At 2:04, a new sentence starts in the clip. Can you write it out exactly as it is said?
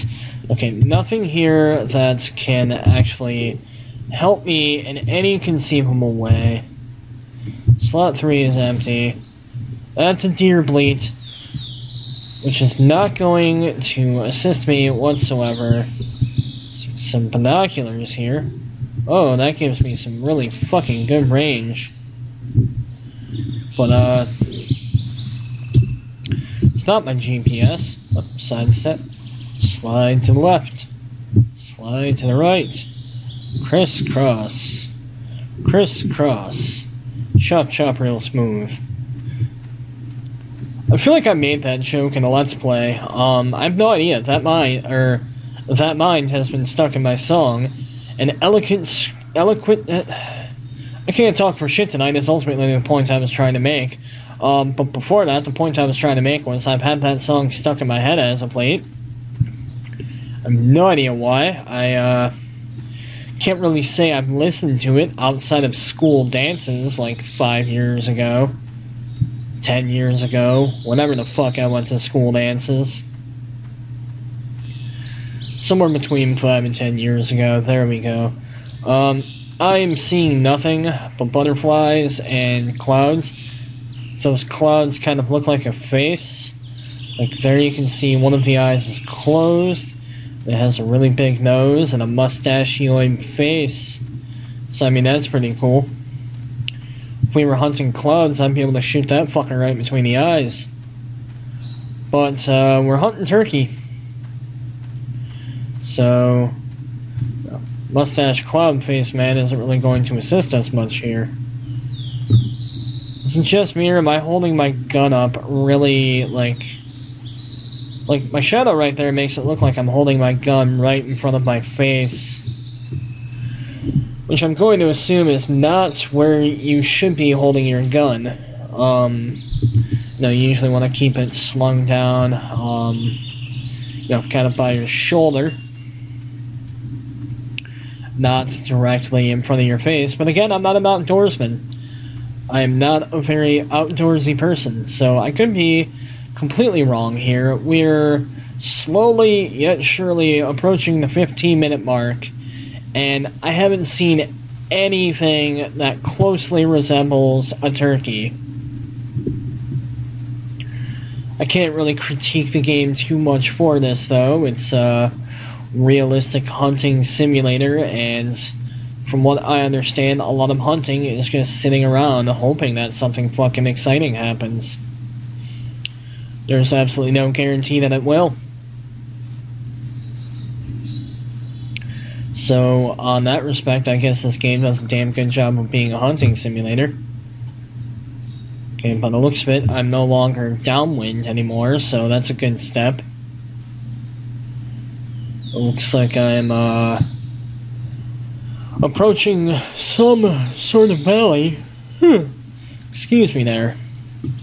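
Which I'm going to assume is not where you should be holding your gun.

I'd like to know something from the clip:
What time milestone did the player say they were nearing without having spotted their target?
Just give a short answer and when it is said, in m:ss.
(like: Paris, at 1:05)
15 minutes, at 2:31.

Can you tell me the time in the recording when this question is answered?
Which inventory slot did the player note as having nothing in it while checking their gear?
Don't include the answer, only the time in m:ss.
0:07.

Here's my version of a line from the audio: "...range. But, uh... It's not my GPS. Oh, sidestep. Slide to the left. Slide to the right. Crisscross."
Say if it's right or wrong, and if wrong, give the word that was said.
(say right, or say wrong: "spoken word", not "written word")
right.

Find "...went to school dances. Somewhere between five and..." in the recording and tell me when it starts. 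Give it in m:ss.
1:11.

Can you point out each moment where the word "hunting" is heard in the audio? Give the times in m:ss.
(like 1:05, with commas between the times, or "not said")
1:37, 1:42, 2:46, 2:50, 3:05.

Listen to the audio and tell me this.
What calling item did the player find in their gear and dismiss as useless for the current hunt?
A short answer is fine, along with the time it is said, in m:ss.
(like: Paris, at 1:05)
Deer bleat, at 0:10.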